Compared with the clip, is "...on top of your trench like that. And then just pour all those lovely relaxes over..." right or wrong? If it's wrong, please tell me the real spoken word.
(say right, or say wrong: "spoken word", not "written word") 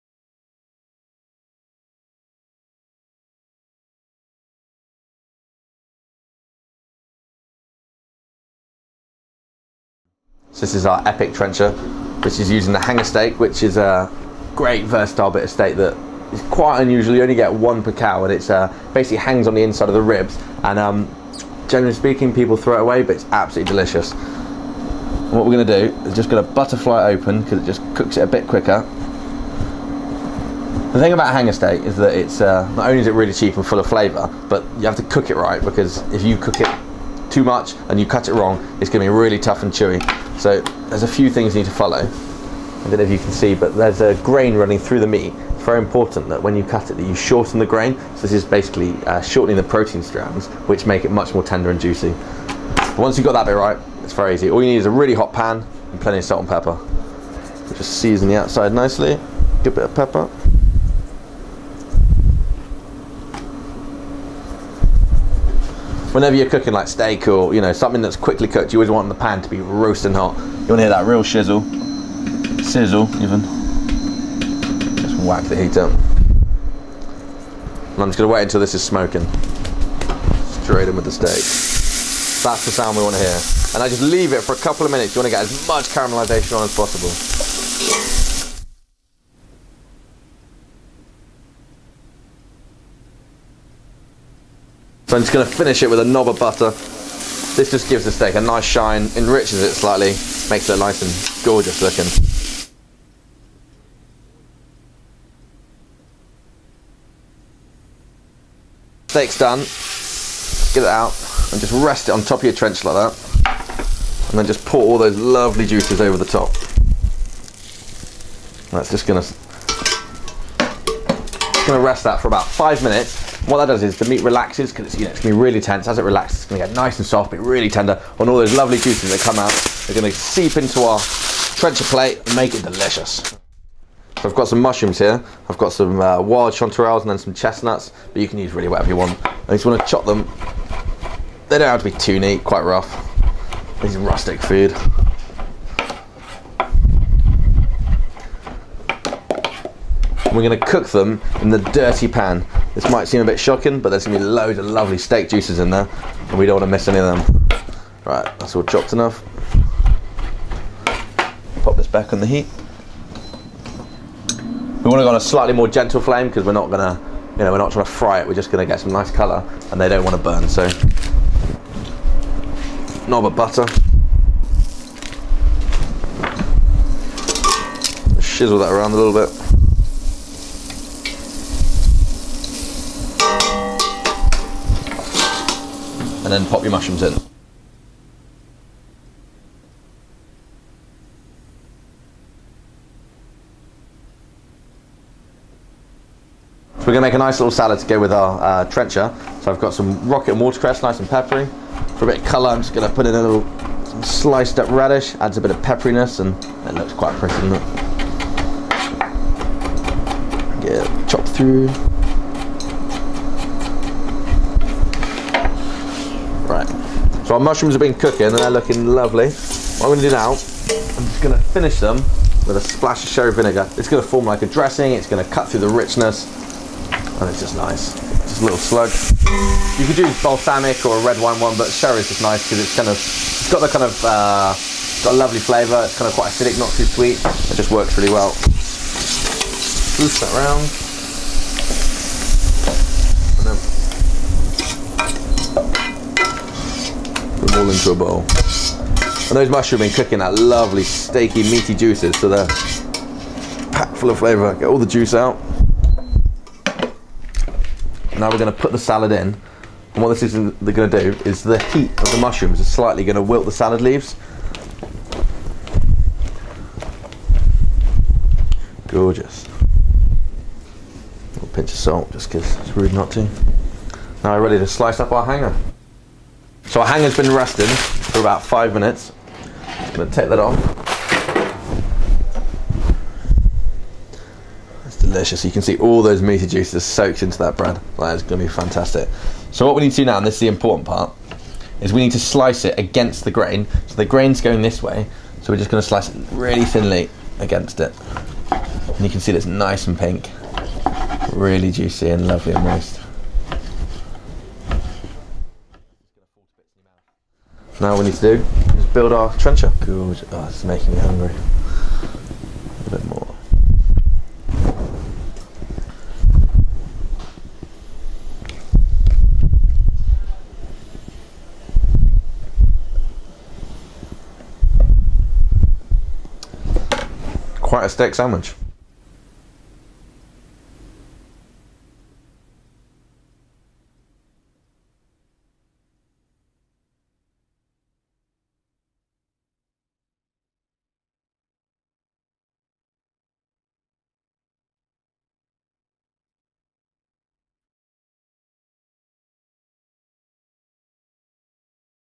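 wrong: "juices", not "relaxes".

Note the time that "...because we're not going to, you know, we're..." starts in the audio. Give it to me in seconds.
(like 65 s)
166 s.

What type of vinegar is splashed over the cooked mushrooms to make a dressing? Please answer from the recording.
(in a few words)
Sherry vinegar.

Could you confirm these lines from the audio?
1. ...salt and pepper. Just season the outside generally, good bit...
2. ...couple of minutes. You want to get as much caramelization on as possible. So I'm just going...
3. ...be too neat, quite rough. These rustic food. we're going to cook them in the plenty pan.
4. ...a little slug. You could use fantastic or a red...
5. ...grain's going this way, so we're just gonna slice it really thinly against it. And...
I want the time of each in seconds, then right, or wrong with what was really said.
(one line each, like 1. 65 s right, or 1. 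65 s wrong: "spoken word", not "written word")
1. 56 s wrong: "nicely", not "generally"
2. 84 s right
3. 141 s wrong: "dirty", not "plenty"
4. 228 s wrong: "balsamic", not "fantastic"
5. 294 s right.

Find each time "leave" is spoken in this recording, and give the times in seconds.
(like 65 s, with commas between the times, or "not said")
84 s, 263 s.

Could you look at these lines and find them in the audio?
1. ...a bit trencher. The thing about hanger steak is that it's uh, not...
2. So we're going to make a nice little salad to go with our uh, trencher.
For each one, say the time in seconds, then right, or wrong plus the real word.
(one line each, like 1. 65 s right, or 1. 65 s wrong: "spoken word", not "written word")
1. 28 s wrong: "quicker", not "trencher"
2. 187 s right.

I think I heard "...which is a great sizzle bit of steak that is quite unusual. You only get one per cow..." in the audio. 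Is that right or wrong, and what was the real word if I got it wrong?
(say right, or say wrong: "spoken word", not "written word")
wrong: "versatile", not "sizzle".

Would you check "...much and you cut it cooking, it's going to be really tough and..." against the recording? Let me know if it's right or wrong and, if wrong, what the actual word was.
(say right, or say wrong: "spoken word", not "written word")
wrong: "wrong", not "cooking".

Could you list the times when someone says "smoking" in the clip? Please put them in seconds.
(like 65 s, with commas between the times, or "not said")
78 s.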